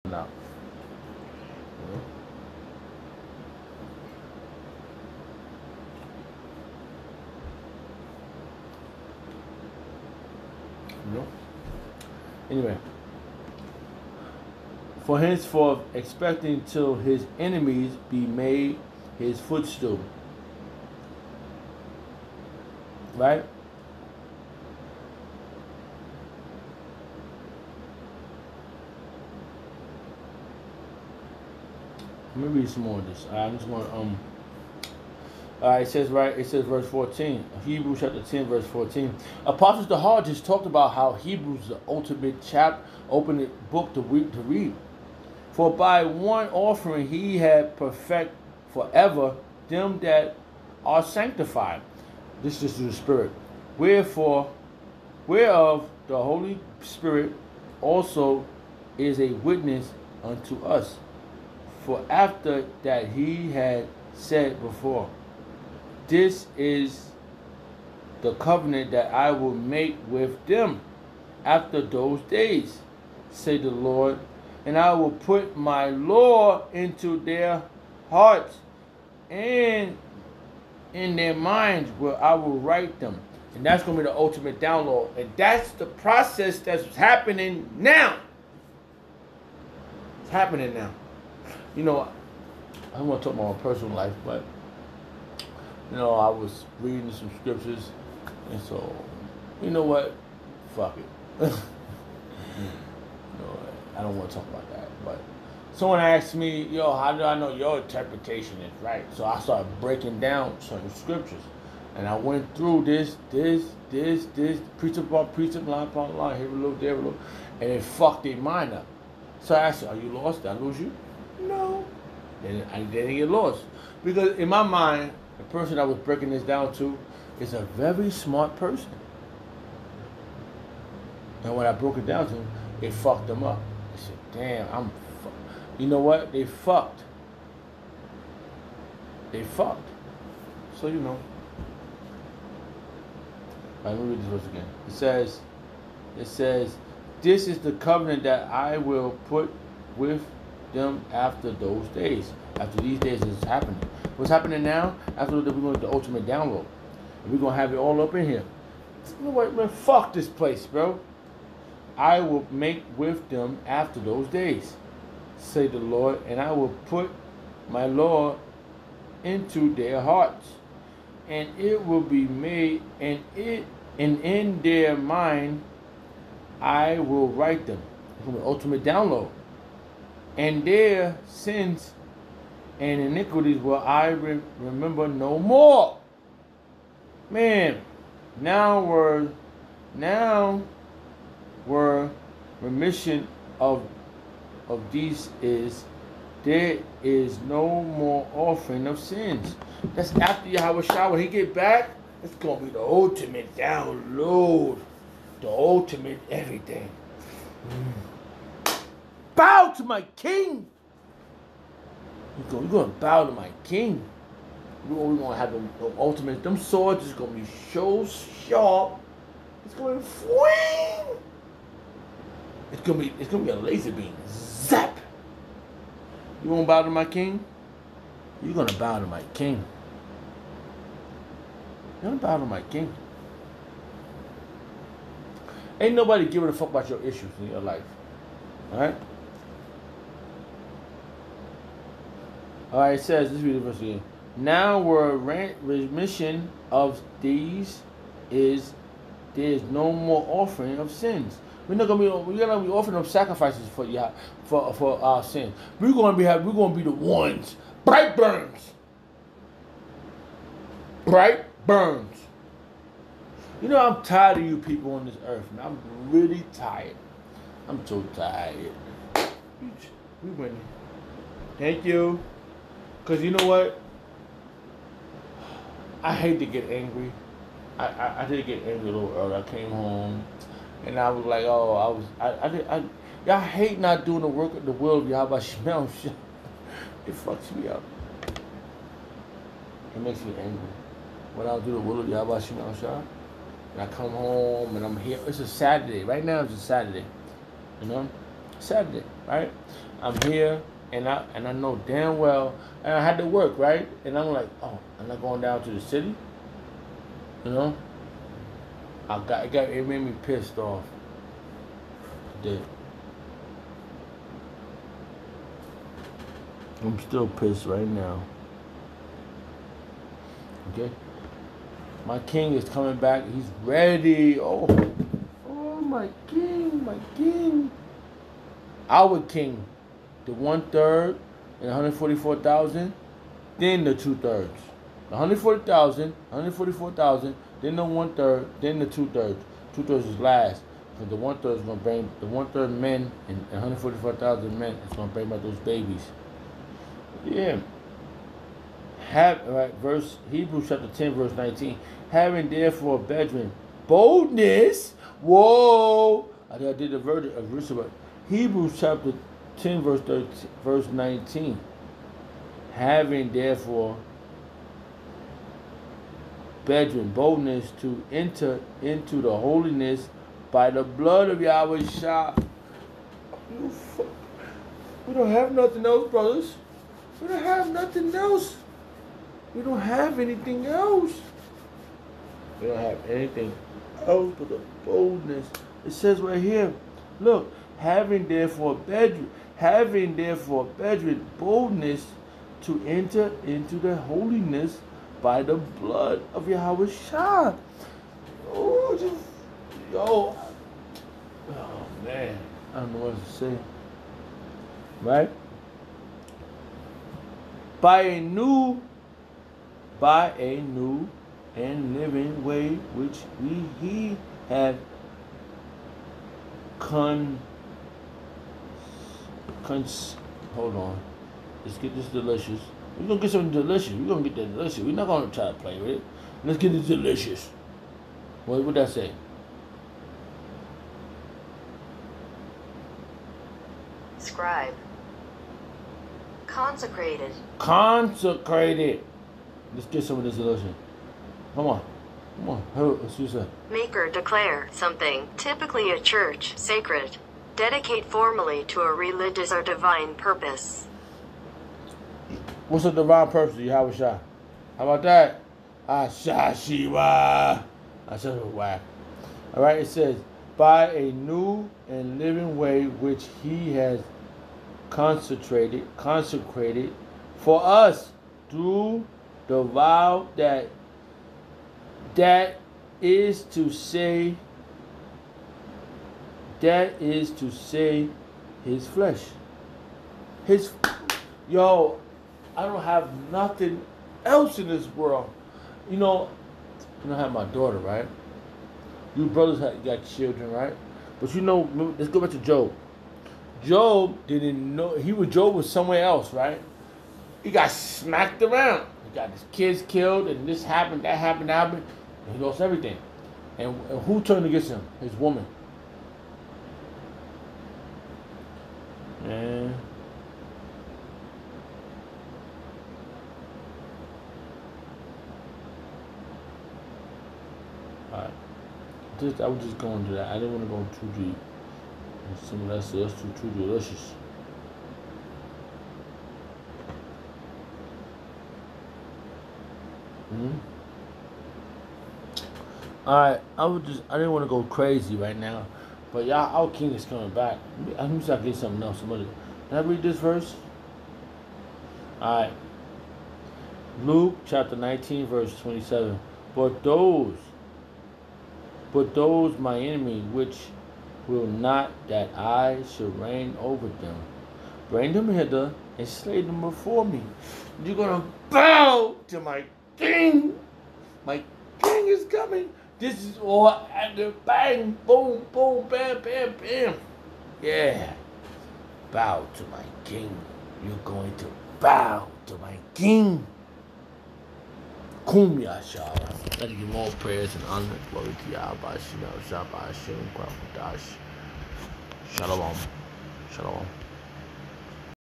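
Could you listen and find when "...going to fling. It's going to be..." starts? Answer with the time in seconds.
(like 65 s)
219 s.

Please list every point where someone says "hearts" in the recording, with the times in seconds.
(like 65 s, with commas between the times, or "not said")
78 s, 170 s.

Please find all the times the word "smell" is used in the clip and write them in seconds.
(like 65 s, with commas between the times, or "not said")
285 s, 292 s.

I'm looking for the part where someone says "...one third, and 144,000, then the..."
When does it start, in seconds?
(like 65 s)
330 s.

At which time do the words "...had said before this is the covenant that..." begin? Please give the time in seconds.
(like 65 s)
63 s.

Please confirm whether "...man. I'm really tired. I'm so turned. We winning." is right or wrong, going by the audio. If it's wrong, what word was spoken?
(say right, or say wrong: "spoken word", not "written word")
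wrong: "tired", not "turned".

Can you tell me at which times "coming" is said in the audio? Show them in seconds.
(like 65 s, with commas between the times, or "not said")
322 s, 537 s, 562 s.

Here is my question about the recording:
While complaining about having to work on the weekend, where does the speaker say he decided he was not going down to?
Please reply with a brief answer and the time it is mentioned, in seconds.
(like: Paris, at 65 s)
the city, at 305 s.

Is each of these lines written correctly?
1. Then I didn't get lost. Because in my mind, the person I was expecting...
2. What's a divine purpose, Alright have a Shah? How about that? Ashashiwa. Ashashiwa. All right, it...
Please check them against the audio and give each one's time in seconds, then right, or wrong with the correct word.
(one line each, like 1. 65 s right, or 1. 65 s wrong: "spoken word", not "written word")
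1. 122 s wrong: "breaking", not "expecting"
2. 452 s wrong: "You", not "Alright".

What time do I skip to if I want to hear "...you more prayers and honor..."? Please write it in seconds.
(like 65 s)
576 s.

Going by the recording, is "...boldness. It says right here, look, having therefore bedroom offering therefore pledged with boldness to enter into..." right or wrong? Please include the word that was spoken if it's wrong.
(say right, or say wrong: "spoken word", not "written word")
wrong: "having", not "offering".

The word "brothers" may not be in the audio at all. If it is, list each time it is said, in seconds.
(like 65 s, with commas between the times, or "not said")
376 s, 489 s.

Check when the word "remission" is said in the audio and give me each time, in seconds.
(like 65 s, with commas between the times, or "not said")
192 s, 245 s.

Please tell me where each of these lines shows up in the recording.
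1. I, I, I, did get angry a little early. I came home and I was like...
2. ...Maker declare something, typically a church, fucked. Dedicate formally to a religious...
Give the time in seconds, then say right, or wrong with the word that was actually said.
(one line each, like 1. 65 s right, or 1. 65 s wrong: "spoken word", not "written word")
1. 277 s right
2. 443 s wrong: "sacred", not "fucked".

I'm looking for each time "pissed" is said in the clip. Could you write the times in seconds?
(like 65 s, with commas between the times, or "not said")
310 s, 317 s.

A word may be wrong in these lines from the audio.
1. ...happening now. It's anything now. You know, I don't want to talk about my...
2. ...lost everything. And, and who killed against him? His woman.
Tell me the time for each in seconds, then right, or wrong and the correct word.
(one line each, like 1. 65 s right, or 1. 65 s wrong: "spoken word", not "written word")
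1. 86 s wrong: "happening", not "anything"
2. 502 s wrong: "turned", not "killed".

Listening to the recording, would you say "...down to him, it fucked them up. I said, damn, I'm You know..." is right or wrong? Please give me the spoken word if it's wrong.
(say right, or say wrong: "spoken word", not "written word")
right.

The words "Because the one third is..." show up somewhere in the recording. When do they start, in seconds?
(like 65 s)
340 s.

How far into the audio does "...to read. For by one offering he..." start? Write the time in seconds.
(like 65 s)
44 s.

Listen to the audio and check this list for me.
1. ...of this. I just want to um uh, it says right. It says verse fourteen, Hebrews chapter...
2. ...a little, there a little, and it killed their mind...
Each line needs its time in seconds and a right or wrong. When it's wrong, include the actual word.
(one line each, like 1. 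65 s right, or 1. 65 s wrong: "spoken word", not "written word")
1. 32 s right
2. 116 s wrong: "fucked", not "killed".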